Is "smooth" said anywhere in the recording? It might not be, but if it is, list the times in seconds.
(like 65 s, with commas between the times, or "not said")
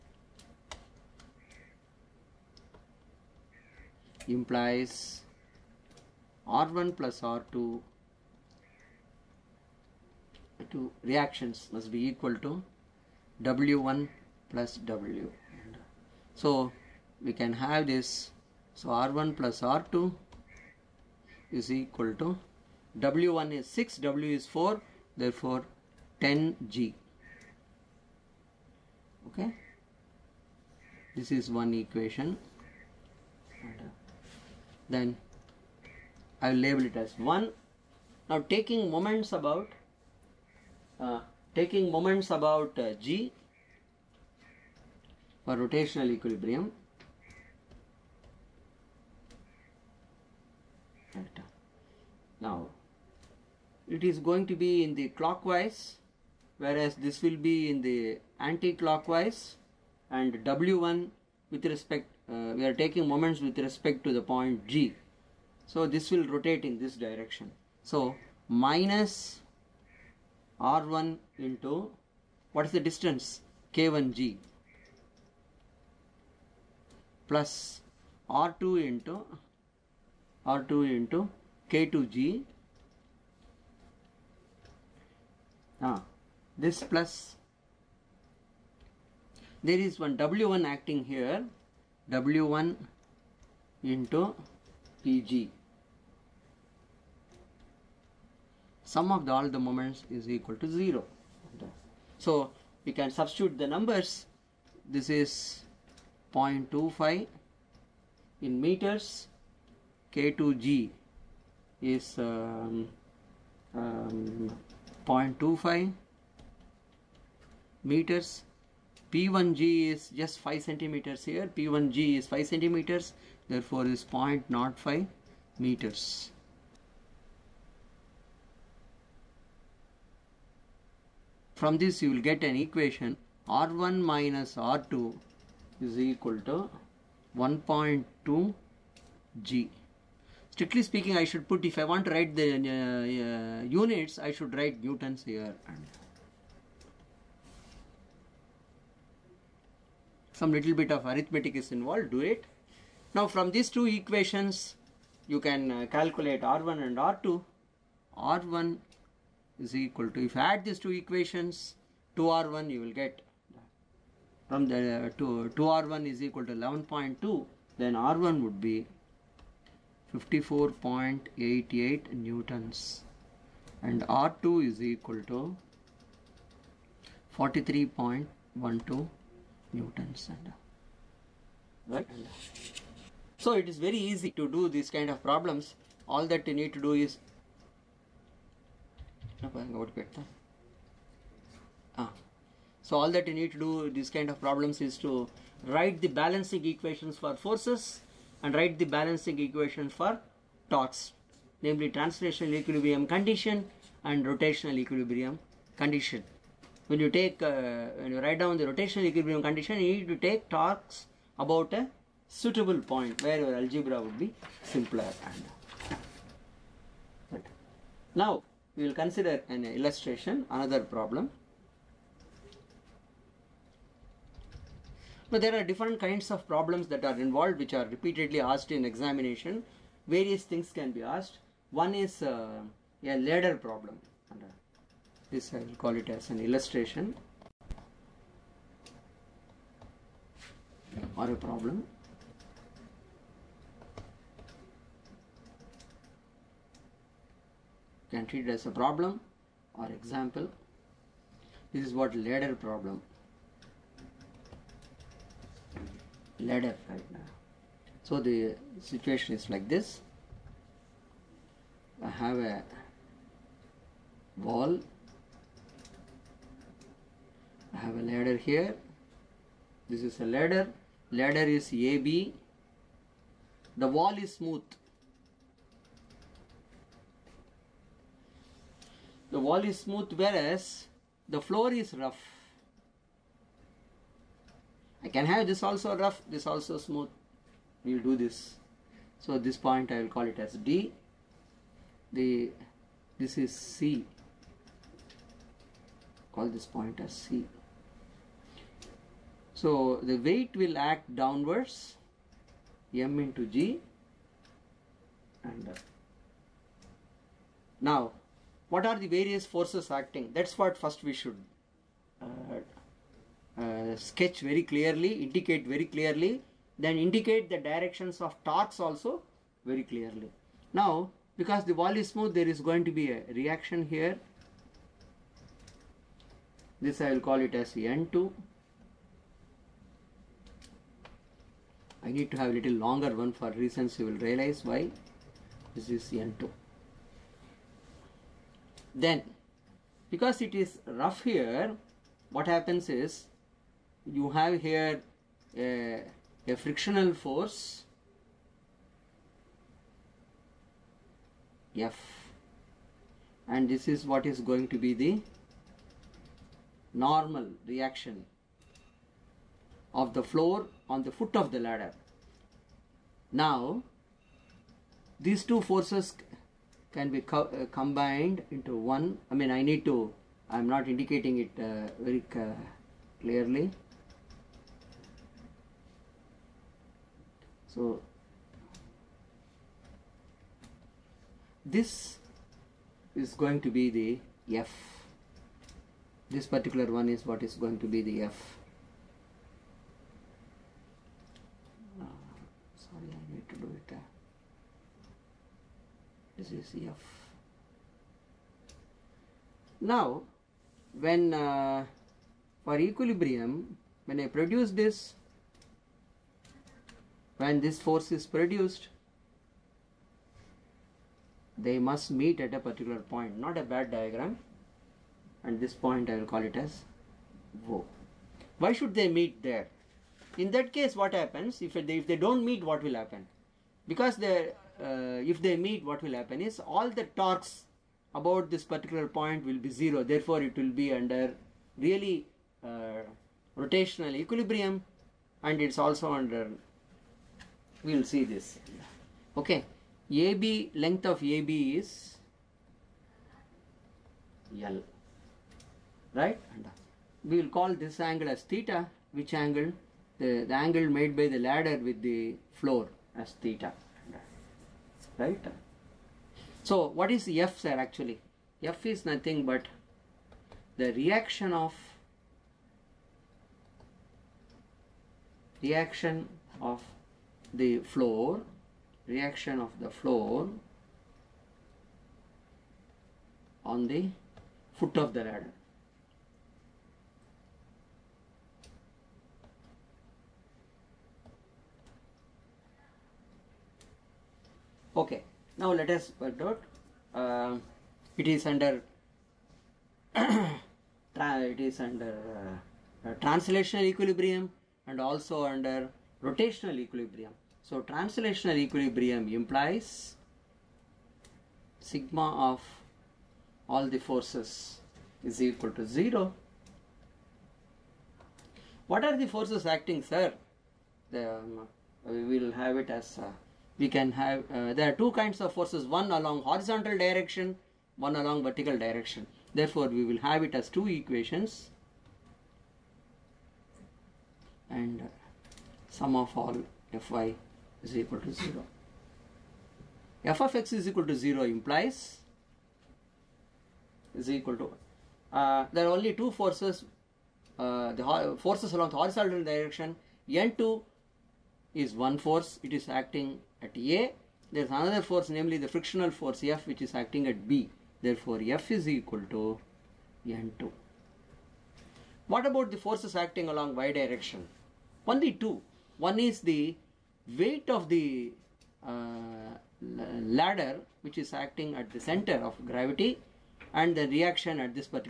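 274 s, 279 s, 286 s, 322 s.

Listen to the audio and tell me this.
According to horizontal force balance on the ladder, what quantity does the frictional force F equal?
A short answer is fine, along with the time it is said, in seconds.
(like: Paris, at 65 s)
N2, at 548 s.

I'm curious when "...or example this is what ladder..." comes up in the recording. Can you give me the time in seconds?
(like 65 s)
249 s.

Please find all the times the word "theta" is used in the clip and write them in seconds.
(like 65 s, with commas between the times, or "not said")
448 s, 453 s.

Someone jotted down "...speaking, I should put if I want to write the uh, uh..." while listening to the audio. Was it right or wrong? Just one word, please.
right.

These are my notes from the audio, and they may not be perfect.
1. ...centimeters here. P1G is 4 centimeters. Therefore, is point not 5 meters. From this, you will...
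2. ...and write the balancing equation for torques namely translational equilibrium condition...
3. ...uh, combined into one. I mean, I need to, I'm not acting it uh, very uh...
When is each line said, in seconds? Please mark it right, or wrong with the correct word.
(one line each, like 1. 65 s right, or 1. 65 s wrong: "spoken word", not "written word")
1. 120 s wrong: "5", not "4"
2. 198 s right
3. 367 s wrong: "indicating", not "acting".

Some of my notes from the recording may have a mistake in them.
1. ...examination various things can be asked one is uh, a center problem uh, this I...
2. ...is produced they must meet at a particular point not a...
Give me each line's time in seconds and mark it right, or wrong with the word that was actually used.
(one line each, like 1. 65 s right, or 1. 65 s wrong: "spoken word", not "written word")
1. 228 s wrong: "ladder", not "center"
2. 408 s right.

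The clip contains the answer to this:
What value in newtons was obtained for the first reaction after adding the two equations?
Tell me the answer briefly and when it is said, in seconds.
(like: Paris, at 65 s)
54.88 newtons, at 170 s.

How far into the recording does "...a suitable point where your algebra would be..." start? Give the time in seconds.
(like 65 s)
211 s.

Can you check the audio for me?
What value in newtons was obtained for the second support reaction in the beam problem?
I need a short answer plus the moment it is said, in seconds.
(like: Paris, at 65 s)
43.12 Newtons, at 177 s.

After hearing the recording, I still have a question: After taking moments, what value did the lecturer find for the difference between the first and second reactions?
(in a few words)
1.2 G.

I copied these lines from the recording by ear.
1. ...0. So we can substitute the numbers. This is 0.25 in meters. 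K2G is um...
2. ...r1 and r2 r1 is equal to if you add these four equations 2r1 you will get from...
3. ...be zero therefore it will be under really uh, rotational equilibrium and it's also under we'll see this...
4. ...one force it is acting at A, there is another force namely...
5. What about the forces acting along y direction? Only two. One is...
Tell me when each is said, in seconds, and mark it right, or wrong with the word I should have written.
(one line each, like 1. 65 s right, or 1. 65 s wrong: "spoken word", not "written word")
1. 100 s right
2. 156 s wrong: "two", not "four"
3. 429 s right
4. 542 s right
5. 552 s right.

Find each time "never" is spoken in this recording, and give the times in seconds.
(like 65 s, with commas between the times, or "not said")
not said.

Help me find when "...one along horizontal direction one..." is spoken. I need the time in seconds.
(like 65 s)
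515 s.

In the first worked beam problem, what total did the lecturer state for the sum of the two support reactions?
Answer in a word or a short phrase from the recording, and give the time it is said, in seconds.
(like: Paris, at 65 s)
10G, at 26 s.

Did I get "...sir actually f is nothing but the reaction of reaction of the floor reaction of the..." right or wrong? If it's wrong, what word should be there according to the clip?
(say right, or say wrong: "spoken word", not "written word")
right.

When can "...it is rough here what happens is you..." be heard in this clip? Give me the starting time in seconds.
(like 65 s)
340 s.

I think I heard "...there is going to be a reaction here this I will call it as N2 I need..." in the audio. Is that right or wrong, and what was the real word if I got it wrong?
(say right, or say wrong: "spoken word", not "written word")
right.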